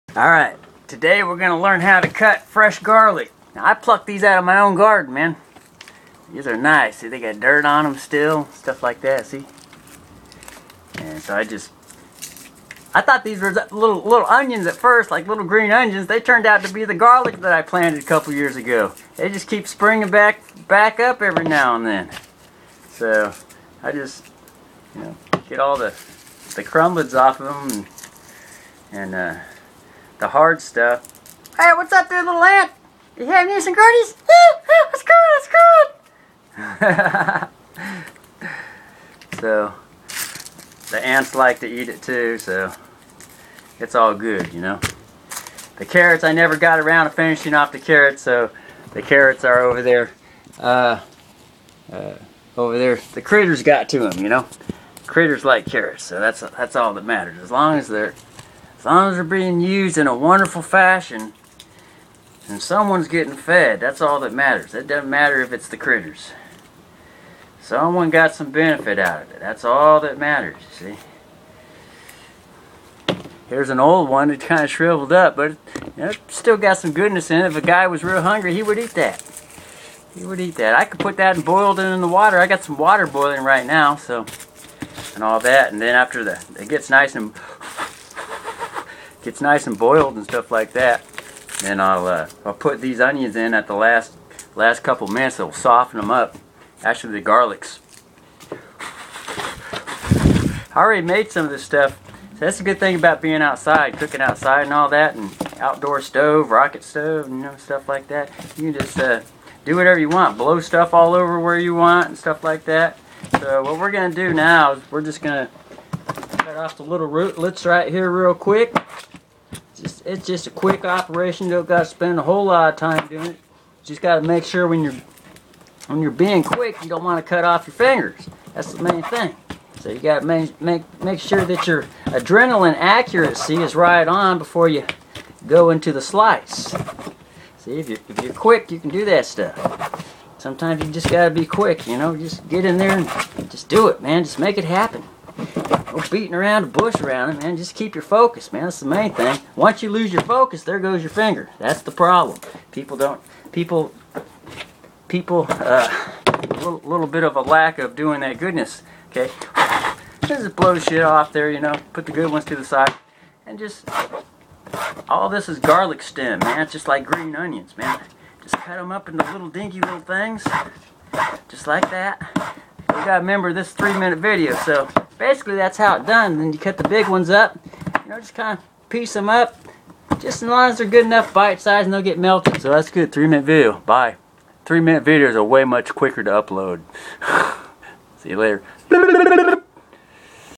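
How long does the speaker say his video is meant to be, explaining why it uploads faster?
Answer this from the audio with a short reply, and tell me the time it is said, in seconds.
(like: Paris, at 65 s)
3 minutes, at 173 s.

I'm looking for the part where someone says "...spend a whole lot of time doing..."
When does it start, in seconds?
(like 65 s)
121 s.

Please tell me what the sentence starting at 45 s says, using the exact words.
The carrots, I never got around to finishing off the carrots, so the carrots are over there.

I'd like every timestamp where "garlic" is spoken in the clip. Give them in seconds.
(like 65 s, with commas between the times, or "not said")
2 s, 16 s, 97 s, 165 s.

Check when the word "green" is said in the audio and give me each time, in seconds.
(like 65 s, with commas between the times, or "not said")
15 s, 167 s.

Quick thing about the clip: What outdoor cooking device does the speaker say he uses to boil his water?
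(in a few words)
Rocket stove.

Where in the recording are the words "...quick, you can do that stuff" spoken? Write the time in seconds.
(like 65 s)
138 s.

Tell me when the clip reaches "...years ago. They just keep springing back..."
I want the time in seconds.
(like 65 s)
18 s.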